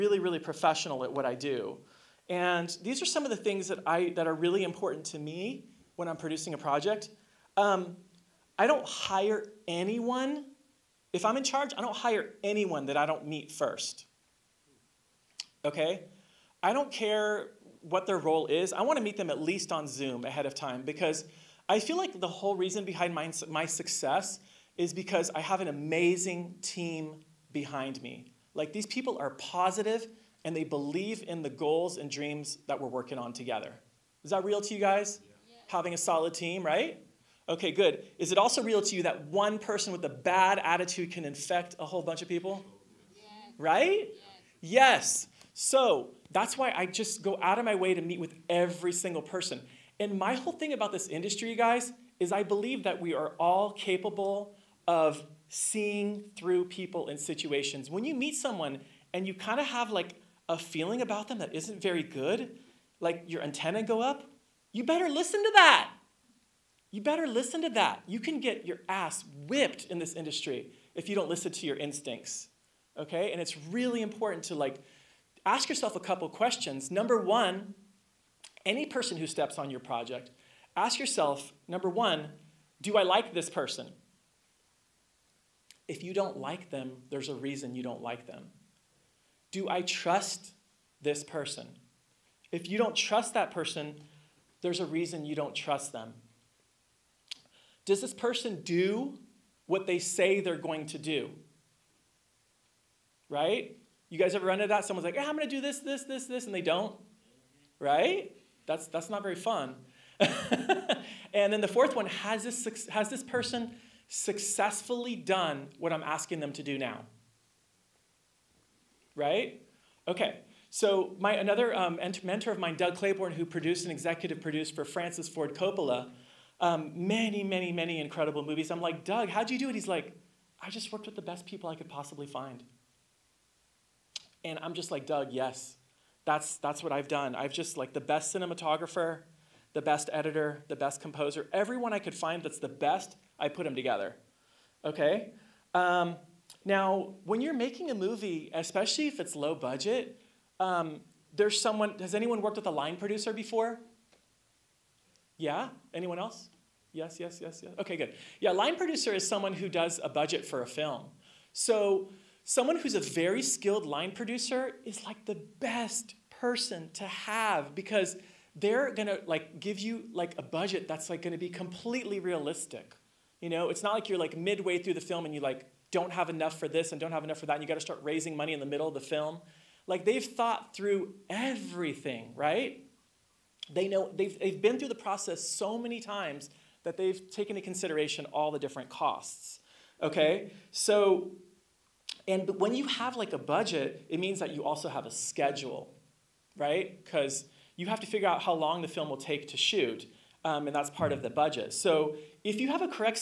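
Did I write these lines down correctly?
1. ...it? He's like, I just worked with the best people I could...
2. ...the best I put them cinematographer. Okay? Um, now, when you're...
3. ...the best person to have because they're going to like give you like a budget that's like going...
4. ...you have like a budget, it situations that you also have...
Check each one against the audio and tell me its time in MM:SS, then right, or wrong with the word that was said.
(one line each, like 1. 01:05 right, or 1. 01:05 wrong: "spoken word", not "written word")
1. 02:09 right
2. 02:22 wrong: "together", not "cinematographer"
3. 02:45 right
4. 03:12 wrong: "means", not "situations".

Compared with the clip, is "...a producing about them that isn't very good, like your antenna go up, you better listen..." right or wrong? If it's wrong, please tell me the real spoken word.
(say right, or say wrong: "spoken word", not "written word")
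wrong: "feeling", not "producing".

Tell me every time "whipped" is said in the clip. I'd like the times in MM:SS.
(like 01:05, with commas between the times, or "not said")
01:09.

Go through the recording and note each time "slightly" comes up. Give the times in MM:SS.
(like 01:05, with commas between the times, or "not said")
not said.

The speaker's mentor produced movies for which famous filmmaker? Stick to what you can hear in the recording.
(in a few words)
Francis Ford Coppola.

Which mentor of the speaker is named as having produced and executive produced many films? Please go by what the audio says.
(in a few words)
Doug Claybourne.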